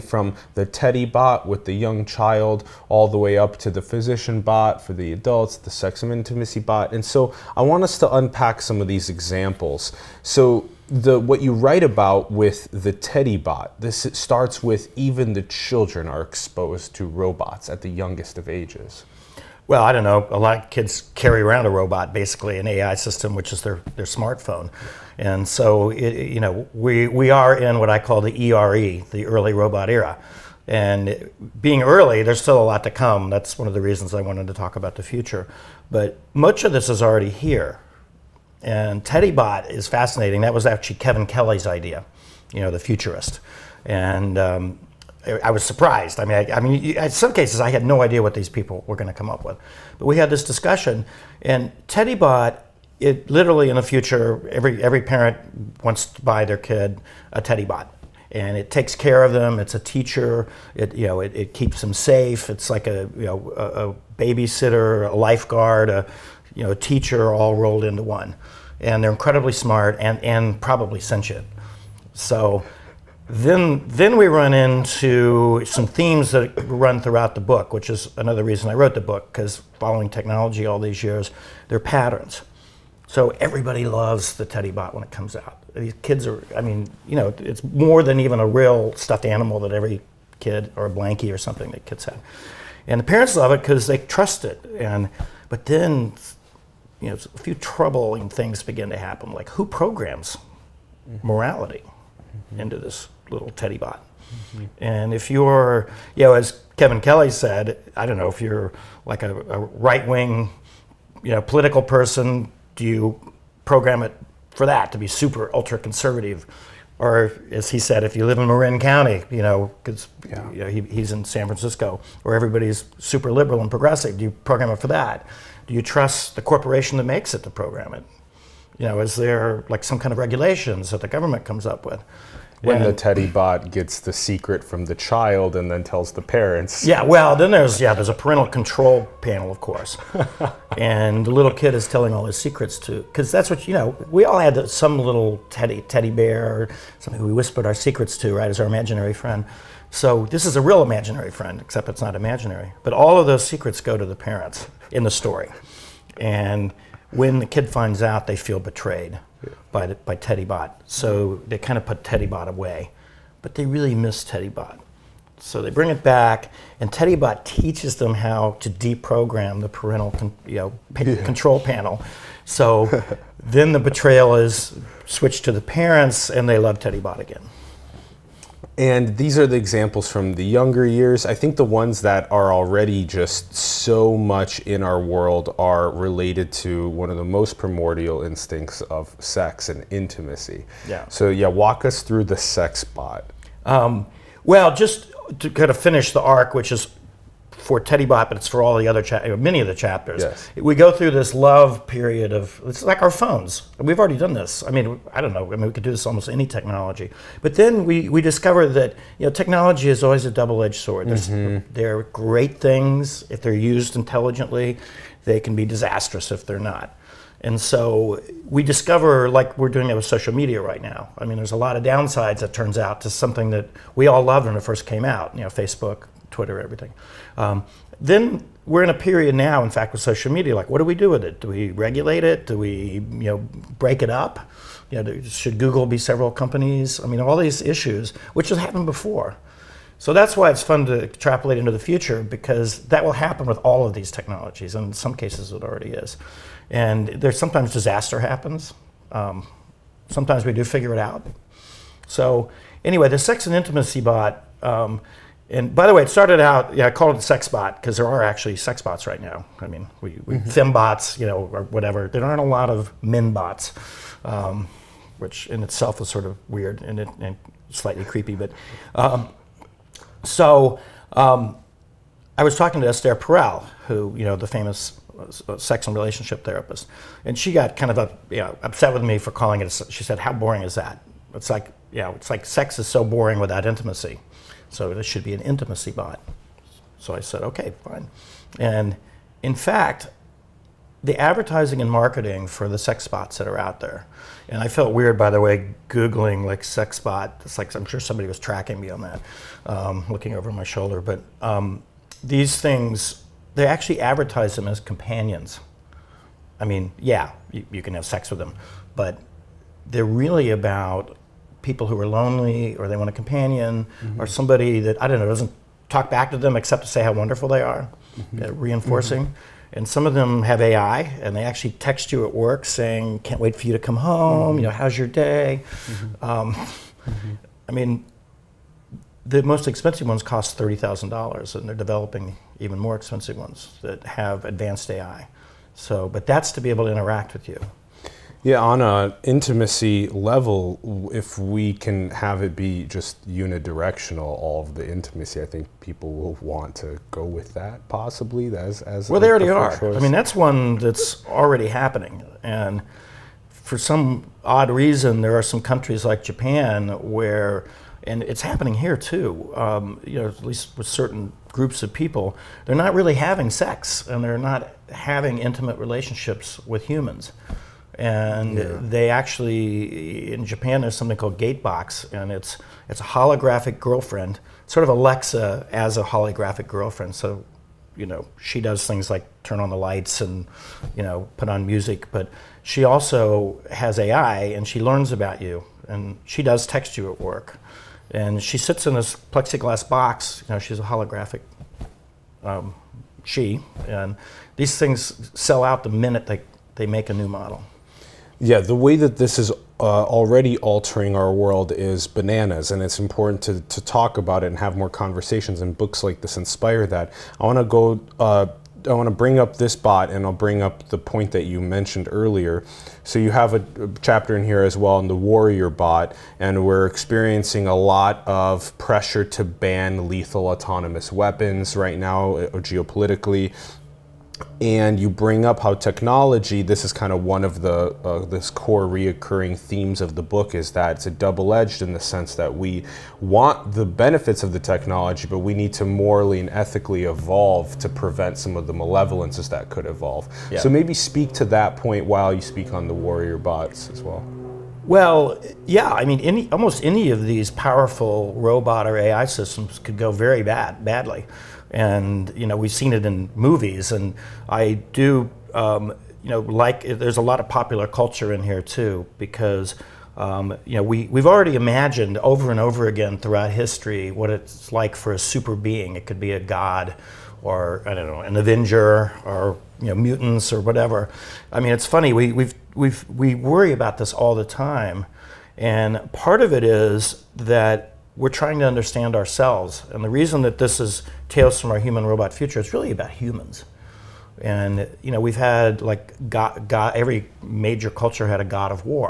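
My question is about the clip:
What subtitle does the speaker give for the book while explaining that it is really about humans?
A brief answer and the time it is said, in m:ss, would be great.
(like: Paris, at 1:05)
Tales from Our Human Robot Future, at 8:01.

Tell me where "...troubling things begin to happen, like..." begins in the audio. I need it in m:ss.
1:37.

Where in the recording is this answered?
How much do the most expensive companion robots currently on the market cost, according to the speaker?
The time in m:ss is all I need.
5:30.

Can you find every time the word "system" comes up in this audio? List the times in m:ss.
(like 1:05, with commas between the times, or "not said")
0:22, 7:29.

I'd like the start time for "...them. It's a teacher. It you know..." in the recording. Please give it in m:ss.
0:59.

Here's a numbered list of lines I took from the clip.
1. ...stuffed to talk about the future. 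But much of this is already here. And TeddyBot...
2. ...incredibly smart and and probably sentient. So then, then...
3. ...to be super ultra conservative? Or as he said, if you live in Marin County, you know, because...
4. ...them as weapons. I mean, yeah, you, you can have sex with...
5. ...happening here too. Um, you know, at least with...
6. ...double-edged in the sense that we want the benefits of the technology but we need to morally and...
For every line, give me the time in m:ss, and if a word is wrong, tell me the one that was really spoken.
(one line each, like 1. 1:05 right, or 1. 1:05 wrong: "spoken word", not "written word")
1. 0:34 wrong: "wanted", not "stuffed"
2. 1:09 right
3. 1:54 right
4. 5:04 wrong: "companions", not "weapons"
5. 5:58 right
6. 7:11 right.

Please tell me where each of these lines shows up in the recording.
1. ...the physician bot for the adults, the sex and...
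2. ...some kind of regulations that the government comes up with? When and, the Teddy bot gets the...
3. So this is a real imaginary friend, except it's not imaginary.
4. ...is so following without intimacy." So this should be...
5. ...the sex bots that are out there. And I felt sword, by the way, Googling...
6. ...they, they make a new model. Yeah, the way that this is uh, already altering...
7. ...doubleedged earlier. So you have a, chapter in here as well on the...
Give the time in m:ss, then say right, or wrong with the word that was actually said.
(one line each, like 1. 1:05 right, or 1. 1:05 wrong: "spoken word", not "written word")
1. 0:03 right
2. 2:09 right
3. 2:29 right
4. 4:42 wrong: "boring", not "following"
5. 4:52 wrong: "weird", not "sword"
6. 6:36 right
7. 6:51 wrong: "mentioned", not "doubleedged".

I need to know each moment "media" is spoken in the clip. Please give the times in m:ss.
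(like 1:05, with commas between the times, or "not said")
3:40, 3:50.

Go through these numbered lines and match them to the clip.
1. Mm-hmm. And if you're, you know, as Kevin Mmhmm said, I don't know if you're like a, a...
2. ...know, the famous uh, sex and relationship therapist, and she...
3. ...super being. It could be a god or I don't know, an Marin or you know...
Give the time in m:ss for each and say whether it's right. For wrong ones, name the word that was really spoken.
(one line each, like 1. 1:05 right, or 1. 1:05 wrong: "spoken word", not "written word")
1. 1:44 wrong: "Kelly", not "Mmhmm"
2. 4:34 right
3. 7:45 wrong: "Avenger", not "Marin".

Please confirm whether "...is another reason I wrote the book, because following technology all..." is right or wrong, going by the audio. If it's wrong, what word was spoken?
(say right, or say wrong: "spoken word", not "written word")
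right.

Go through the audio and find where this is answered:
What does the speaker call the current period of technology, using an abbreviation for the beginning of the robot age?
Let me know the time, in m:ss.
0:28.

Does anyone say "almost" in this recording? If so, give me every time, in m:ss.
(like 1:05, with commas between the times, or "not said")
3:26, 7:26.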